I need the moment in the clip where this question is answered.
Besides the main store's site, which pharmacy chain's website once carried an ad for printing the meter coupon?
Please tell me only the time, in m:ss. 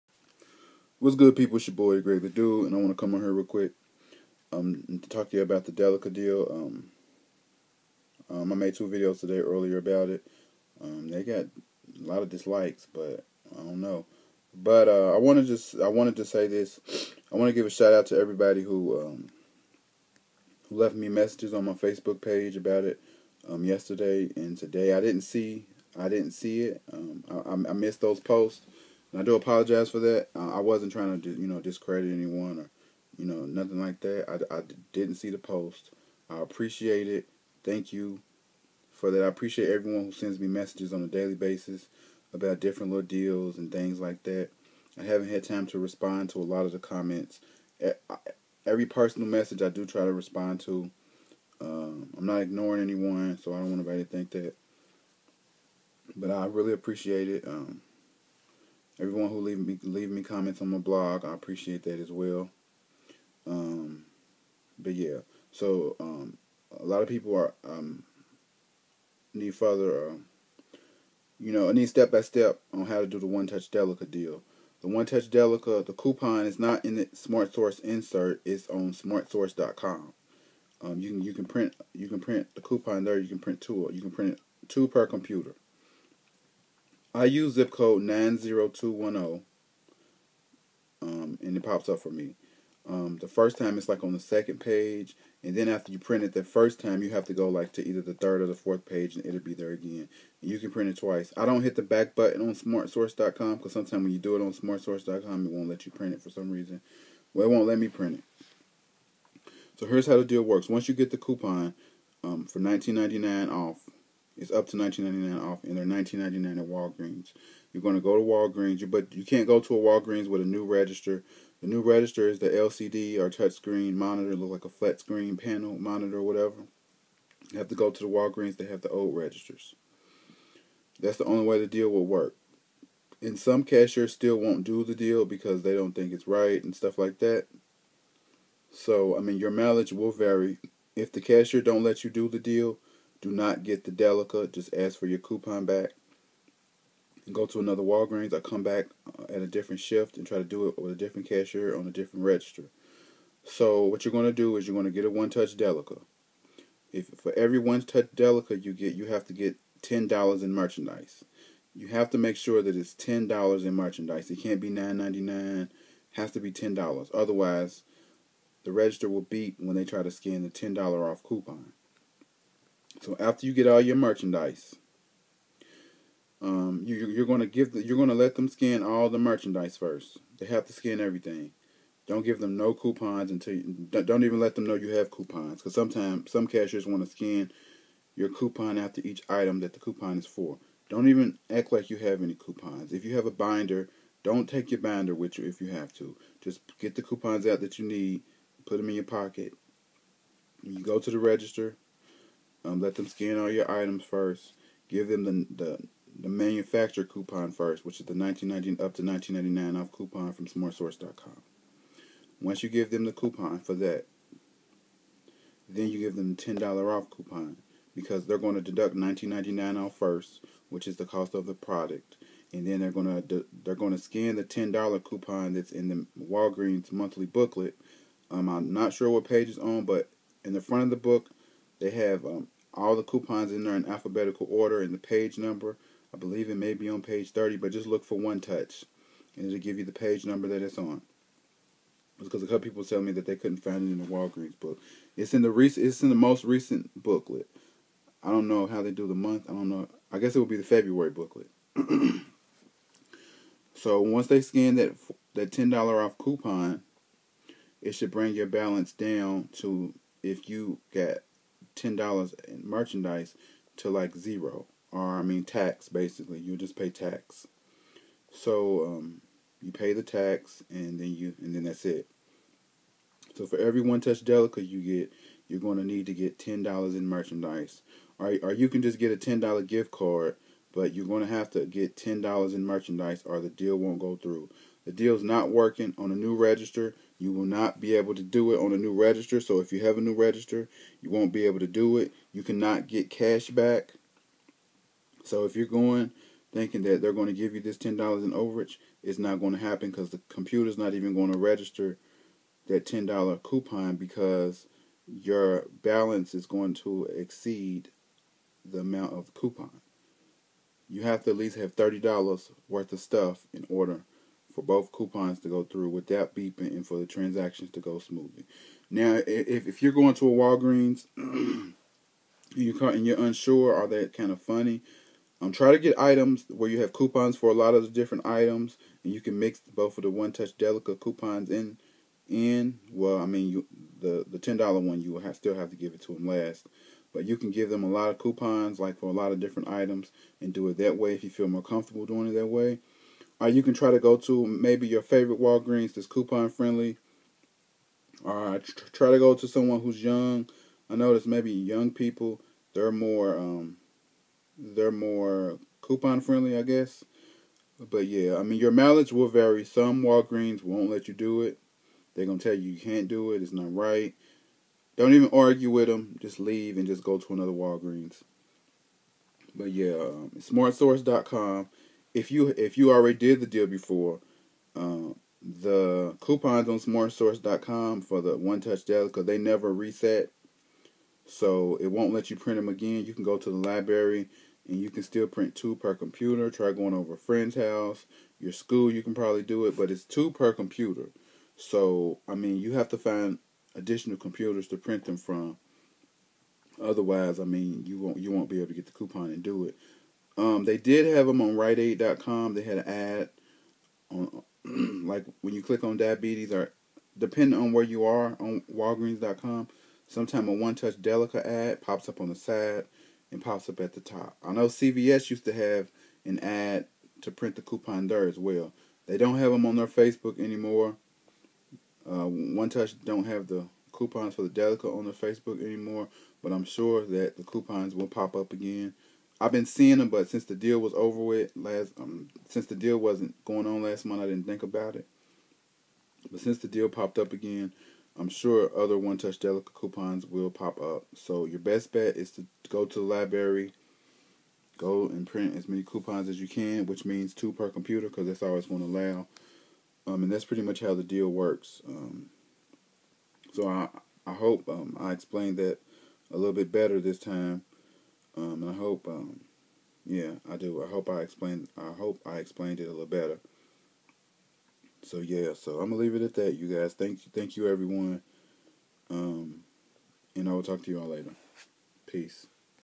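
6:41.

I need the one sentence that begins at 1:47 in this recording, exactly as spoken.
Well, it won't let me print it.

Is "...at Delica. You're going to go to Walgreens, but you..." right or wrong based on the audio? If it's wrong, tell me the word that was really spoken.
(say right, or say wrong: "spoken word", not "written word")
wrong: "Walgreens", not "Delica".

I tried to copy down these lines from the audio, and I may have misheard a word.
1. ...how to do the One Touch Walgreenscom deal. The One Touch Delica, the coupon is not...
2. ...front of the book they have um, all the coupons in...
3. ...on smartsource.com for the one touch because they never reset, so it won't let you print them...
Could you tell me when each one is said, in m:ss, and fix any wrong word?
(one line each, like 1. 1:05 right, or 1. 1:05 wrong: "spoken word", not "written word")
1. 1:12 wrong: "Delica", not "Walgreenscom"
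2. 3:50 right
3. 6:16 right.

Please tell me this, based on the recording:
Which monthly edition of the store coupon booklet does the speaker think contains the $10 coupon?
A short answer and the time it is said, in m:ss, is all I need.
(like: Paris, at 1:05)
February, at 4:10.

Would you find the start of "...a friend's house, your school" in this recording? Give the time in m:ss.
6:27.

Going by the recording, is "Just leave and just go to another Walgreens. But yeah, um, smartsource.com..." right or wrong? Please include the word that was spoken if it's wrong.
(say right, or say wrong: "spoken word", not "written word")
right.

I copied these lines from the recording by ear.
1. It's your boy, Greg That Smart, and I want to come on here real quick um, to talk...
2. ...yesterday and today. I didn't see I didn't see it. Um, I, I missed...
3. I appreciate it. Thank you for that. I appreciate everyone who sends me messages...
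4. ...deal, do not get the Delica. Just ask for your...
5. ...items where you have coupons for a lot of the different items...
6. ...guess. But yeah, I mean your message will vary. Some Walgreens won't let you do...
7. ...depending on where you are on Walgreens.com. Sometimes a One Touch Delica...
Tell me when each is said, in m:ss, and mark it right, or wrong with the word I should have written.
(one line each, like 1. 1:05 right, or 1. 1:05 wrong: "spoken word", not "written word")
1. 0:01 wrong: "Dude", not "Smart"
2. 0:23 right
3. 0:36 right
4. 2:22 right
5. 5:25 right
6. 5:56 wrong: "mileage", not "message"
7. 6:47 right.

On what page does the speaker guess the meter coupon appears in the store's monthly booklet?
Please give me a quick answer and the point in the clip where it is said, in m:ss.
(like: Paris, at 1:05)
Page 30, at 3:57.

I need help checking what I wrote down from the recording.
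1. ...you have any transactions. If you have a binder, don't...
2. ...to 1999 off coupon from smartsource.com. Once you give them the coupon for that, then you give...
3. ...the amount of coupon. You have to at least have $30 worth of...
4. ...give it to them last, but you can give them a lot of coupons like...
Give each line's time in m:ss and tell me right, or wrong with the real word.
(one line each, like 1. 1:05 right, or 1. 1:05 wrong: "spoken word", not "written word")
1. 3:11 wrong: "coupons", not "transactions"
2. 3:28 right
3. 5:08 right
4. 5:35 right.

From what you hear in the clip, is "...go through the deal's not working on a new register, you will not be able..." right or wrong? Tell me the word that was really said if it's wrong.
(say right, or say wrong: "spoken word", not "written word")
right.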